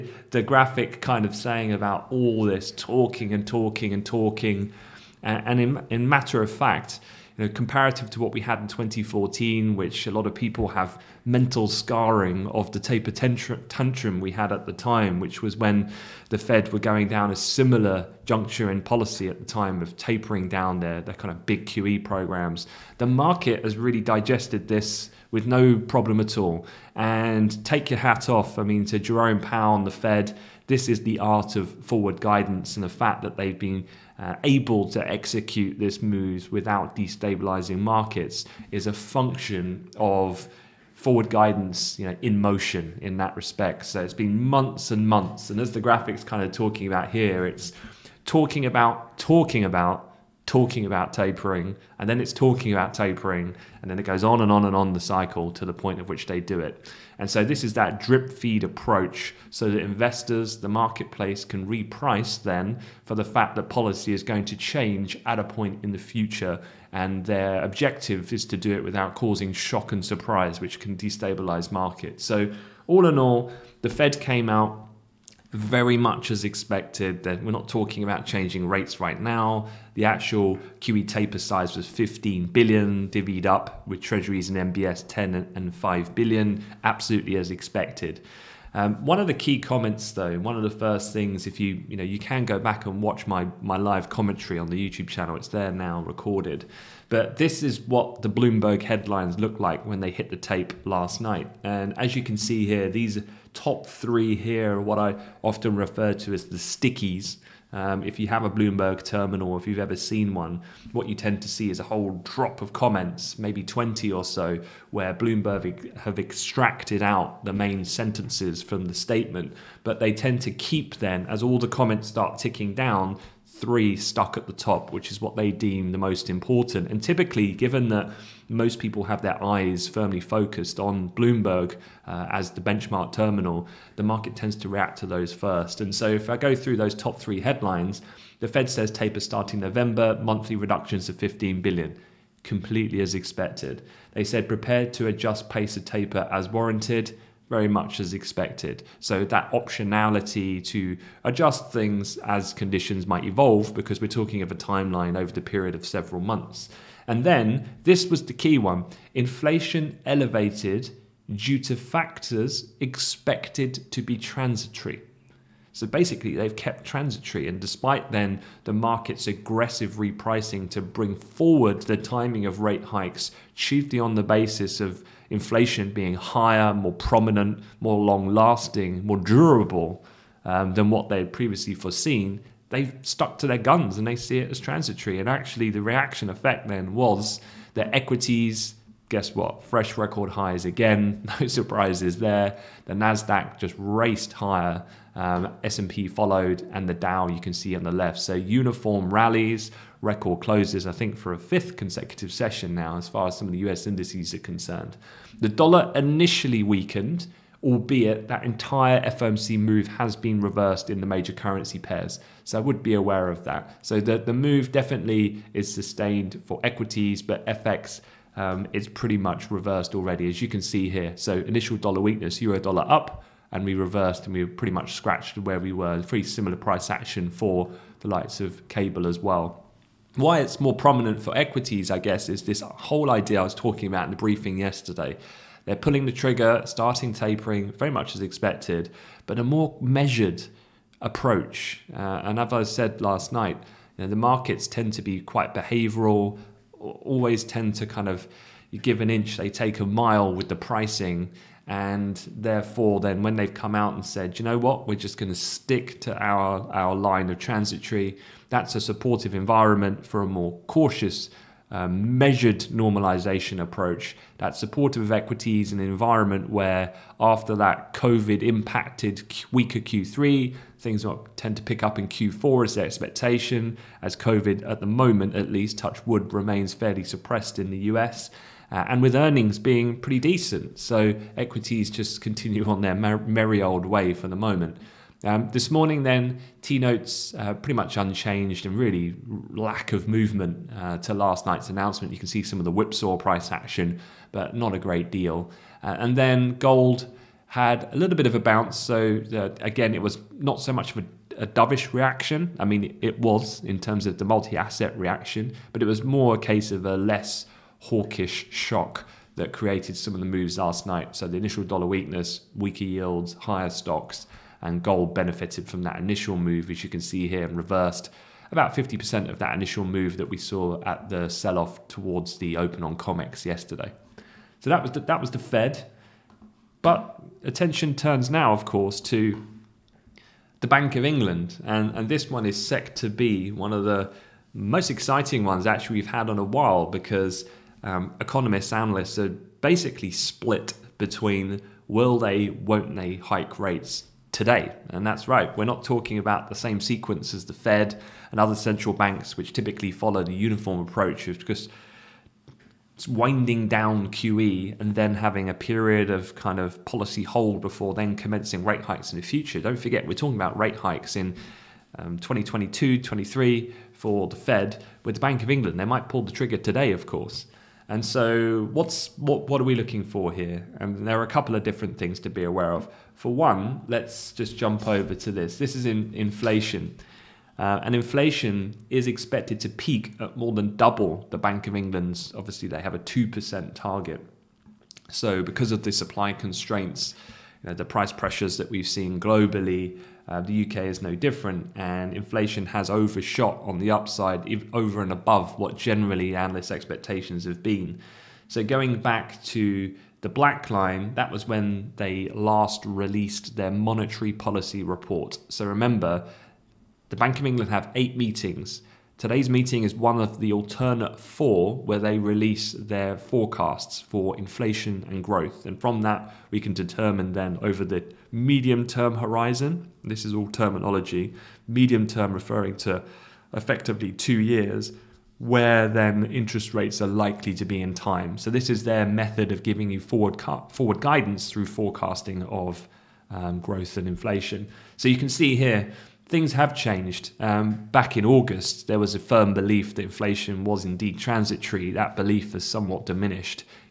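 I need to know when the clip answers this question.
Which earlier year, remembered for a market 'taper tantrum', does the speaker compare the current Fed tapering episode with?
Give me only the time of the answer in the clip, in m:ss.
0:08.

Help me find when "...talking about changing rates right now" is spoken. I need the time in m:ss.
1:17.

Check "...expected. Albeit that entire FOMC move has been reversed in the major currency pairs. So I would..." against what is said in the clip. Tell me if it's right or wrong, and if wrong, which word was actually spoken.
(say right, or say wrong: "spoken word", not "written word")
wrong: "weakened", not "expected".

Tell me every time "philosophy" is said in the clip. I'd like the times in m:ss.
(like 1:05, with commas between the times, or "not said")
not said.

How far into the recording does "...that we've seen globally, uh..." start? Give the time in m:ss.
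6:28.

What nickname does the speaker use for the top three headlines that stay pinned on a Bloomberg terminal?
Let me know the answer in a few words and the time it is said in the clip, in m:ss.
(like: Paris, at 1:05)
the stickies, at 1:46.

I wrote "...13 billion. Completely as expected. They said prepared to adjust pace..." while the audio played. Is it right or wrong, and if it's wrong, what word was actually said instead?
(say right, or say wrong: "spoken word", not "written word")
wrong: "15", not "13".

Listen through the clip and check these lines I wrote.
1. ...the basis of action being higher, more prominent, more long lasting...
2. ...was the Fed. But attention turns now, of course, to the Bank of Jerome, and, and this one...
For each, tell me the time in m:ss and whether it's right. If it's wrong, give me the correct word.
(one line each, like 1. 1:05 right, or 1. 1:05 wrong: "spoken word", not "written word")
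1. 2:54 wrong: "inflation", not "action"
2. 5:25 wrong: "England", not "Jerome".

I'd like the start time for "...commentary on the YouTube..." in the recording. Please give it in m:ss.
1:34.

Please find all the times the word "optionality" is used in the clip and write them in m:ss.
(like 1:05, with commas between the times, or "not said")
2:29.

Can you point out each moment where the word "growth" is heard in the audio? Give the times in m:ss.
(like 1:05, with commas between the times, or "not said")
6:55, 7:13.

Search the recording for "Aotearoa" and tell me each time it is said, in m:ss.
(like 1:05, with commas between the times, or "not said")
not said.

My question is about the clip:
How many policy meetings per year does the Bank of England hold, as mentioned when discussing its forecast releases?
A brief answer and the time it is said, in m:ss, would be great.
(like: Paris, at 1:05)
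8, at 6:47.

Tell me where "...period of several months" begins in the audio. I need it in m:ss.
2:35.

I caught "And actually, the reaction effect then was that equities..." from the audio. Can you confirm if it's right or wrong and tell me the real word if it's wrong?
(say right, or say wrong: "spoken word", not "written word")
right.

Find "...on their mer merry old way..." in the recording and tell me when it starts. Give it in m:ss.
4:42.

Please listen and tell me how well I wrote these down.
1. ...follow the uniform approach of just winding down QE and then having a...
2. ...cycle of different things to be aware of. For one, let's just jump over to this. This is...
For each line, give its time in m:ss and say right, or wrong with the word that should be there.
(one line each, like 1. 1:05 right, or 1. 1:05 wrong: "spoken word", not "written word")
1. 5:49 right
2. 6:11 wrong: "couple", not "cycle".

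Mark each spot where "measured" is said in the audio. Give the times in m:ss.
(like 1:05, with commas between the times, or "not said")
3:59, 4:21.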